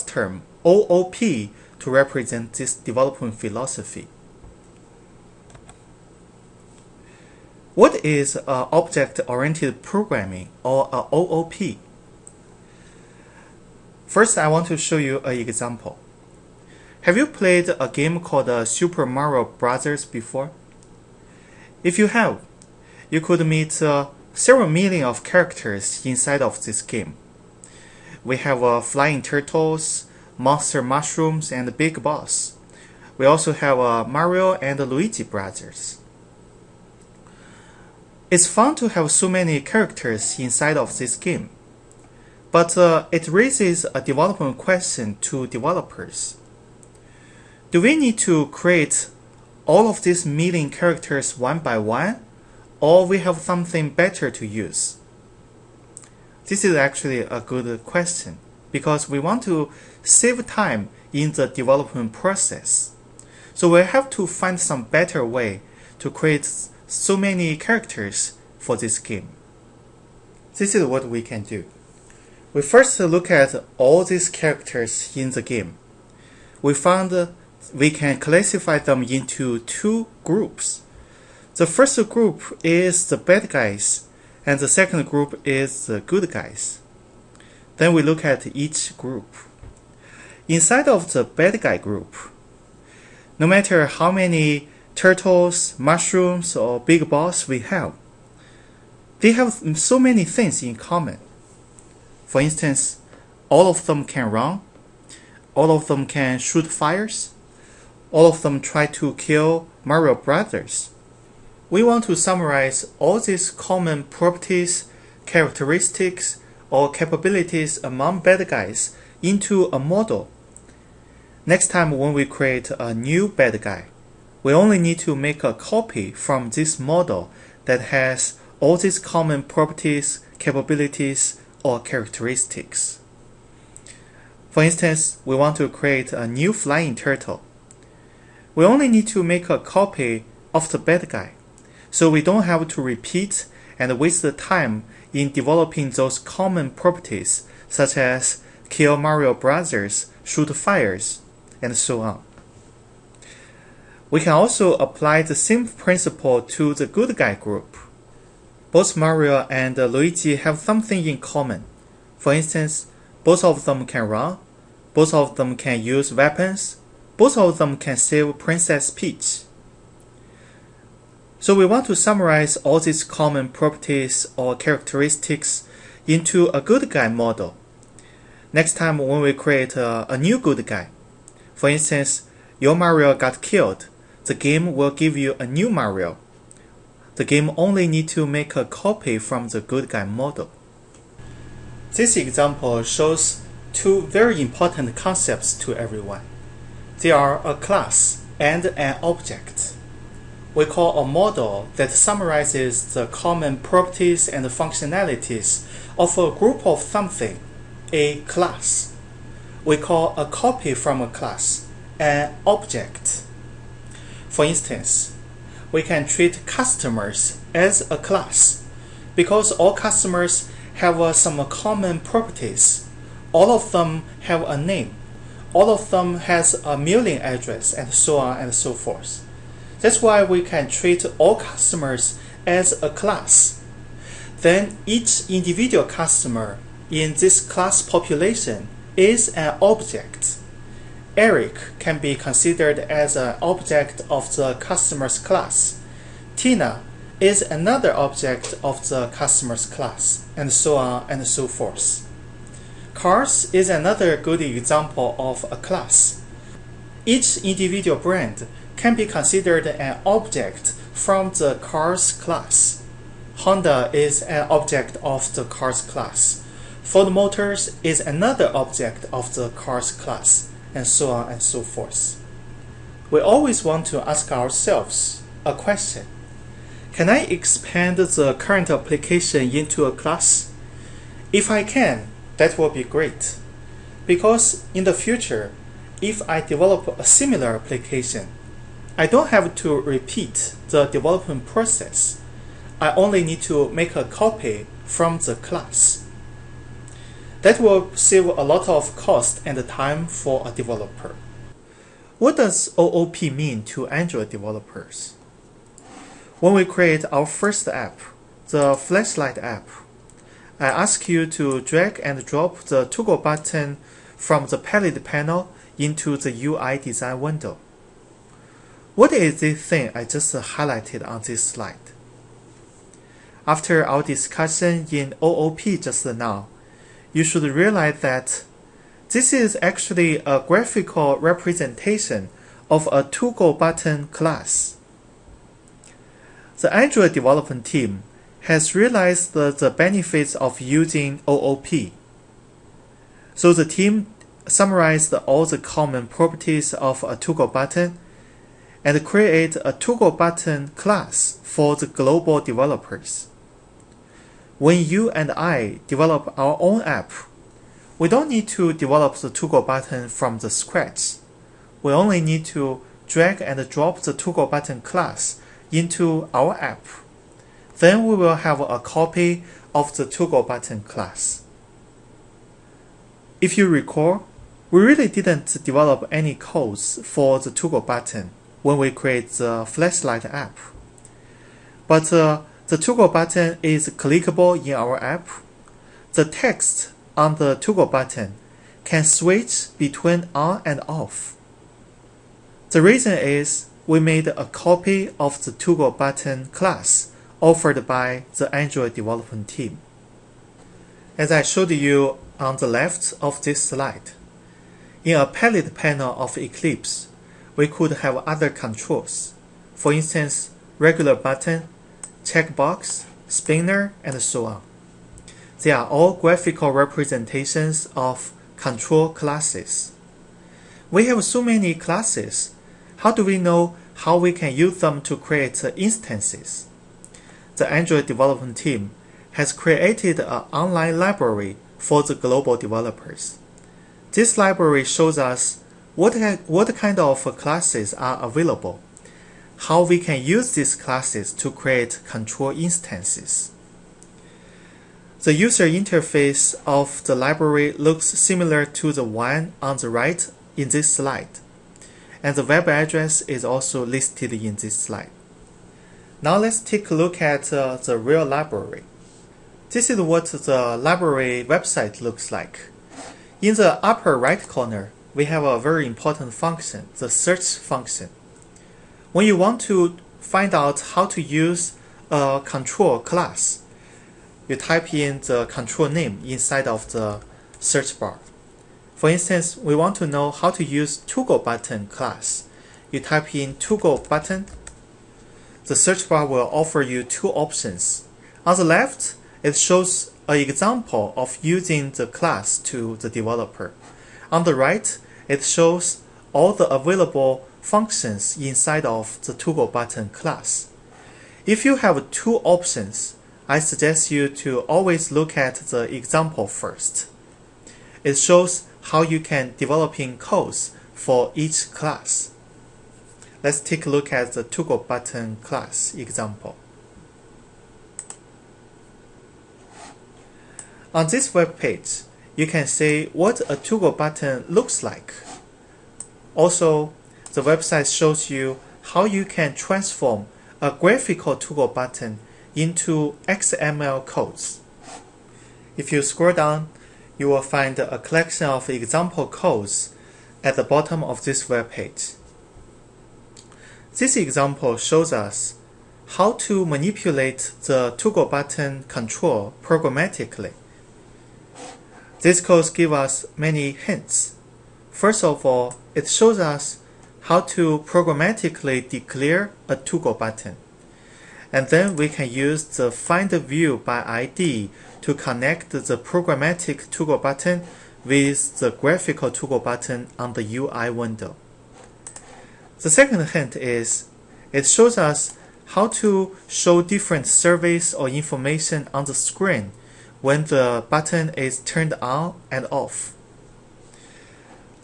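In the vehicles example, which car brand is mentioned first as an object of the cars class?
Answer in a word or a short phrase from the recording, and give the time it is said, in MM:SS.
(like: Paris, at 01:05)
Honda, at 04:23.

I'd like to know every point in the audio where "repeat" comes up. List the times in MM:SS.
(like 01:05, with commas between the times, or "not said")
02:22, 04:49.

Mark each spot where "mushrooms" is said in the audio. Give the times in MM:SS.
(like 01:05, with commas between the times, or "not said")
00:30, 01:35.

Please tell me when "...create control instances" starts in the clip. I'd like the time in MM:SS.
07:21.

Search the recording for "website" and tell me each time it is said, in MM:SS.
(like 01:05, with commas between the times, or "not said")
07:41, 08:47.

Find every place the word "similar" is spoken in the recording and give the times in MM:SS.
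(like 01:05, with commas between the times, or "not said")
04:47, 07:28.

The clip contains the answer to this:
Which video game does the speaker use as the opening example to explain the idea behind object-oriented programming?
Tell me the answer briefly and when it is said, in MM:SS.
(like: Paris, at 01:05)
Super Mario Brothers, at 00:18.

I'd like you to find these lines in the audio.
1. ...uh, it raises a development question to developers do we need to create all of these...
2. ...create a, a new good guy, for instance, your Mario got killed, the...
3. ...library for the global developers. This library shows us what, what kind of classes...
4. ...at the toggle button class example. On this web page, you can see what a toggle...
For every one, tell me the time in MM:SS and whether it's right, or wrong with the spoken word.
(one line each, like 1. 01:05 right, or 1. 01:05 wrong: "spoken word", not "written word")
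1. 00:42 right
2. 02:59 right
3. 07:10 right
4. 08:34 right.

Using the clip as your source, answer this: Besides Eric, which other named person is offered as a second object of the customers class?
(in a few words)
Tina.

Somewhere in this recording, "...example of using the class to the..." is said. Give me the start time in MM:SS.
08:10.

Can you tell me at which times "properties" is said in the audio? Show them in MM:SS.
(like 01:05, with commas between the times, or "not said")
01:54, 02:09, 02:26, 02:53, 03:23, 03:41, 05:46.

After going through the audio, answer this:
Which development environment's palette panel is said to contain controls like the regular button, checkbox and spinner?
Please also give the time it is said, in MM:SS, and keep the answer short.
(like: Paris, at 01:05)
Eclipse, at 06:46.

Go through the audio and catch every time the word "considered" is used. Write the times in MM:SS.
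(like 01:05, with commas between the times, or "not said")
04:02, 04:19.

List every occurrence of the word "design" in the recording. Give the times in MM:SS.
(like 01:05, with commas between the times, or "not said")
05:16.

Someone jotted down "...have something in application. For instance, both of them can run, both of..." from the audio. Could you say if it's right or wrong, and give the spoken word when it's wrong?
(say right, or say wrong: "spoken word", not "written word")
wrong: "common", not "application".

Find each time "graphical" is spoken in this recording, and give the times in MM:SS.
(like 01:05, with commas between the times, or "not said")
05:30, 06:56, 08:50, 09:28.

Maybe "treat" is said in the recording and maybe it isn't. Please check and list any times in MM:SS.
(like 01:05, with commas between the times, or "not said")
03:36, 03:50.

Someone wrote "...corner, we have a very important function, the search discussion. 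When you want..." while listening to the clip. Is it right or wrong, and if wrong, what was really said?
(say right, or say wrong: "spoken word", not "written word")
wrong: "function", not "discussion".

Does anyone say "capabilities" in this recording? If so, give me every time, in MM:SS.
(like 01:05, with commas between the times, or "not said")
01:56, 02:10.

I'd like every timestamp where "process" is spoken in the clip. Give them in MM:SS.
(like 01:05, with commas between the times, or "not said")
01:02, 04:51.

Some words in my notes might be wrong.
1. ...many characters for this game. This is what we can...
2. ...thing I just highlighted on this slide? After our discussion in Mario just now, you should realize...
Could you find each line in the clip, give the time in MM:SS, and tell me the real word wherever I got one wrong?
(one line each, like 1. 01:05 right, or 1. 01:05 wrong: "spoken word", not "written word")
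1. 01:07 right
2. 05:19 wrong: "OOP", not "Mario".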